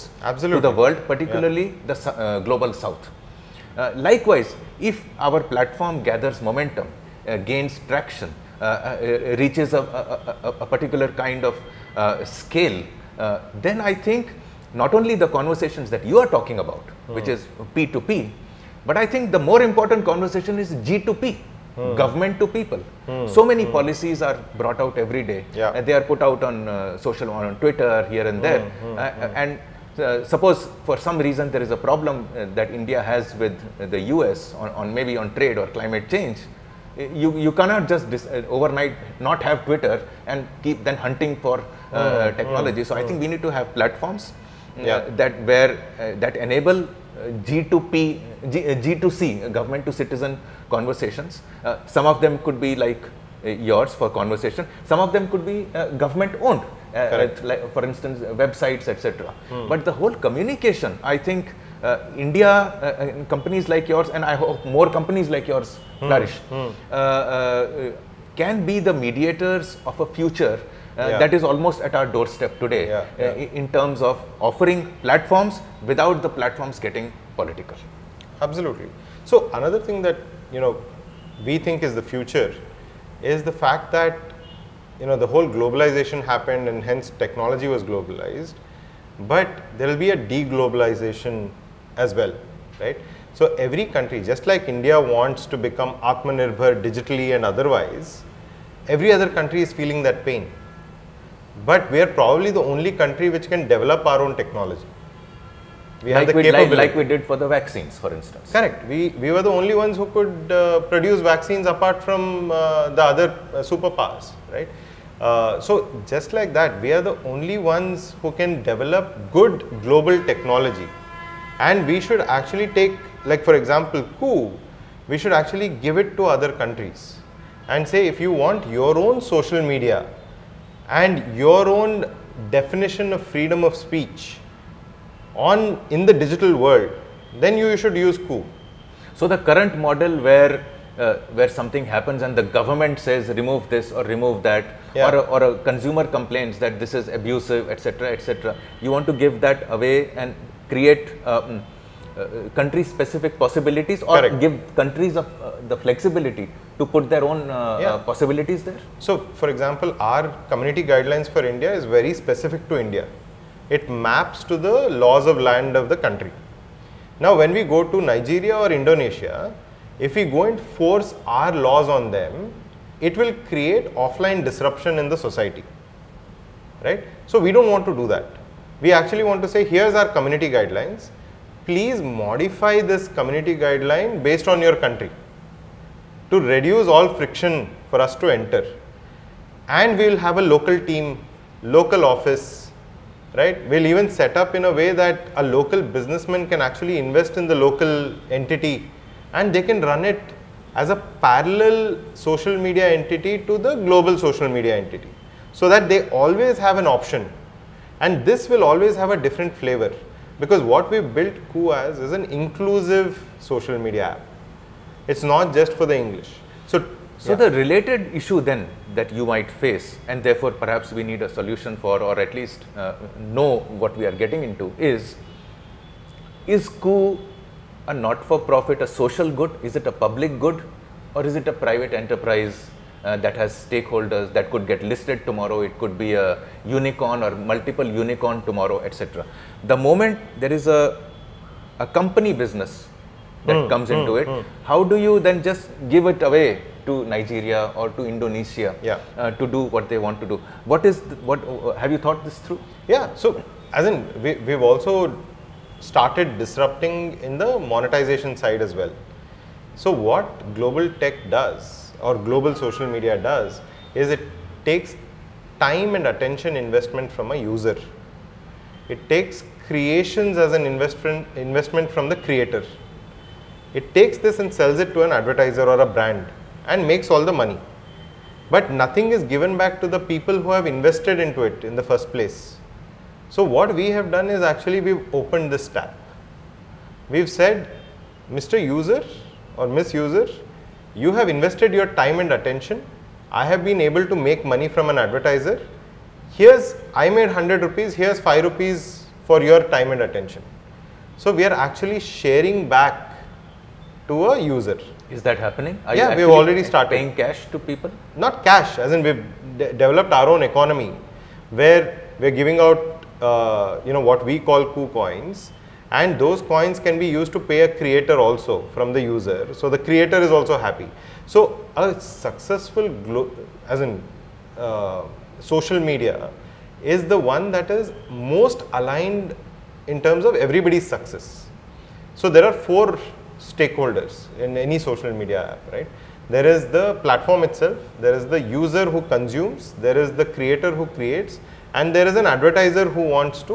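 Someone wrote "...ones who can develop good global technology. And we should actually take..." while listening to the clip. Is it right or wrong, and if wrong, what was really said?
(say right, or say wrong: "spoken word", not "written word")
right.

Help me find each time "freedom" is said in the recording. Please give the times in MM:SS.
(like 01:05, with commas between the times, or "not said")
02:13.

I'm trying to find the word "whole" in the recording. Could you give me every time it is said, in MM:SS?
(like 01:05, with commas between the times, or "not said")
00:59, 01:25.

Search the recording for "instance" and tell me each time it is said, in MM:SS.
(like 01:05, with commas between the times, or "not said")
00:57, 01:48.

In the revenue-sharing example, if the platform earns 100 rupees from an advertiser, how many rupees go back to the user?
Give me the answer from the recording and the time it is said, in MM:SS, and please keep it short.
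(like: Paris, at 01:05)
5 rupees, at 04:58.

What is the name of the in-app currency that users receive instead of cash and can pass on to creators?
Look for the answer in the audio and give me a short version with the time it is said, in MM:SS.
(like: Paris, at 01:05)
KooCoins, at 05:14.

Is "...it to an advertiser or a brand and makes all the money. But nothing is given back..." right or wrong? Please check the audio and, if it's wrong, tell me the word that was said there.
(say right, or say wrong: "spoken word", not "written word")
right.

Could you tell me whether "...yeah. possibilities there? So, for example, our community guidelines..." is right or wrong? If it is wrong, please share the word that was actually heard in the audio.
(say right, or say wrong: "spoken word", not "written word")
right.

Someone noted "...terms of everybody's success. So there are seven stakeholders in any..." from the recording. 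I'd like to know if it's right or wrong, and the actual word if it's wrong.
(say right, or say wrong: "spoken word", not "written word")
wrong: "four", not "seven".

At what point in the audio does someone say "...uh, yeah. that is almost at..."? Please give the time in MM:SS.
01:10.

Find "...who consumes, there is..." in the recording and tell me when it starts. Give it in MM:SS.
05:38.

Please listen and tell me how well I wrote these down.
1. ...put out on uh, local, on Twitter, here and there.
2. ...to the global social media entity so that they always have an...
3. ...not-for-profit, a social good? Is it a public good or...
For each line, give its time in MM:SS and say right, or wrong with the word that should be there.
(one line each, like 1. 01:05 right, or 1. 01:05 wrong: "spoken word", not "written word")
1. 00:26 wrong: "social", not "local"
2. 03:23 right
3. 03:47 right.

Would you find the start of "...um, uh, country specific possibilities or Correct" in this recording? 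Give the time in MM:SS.
02:31.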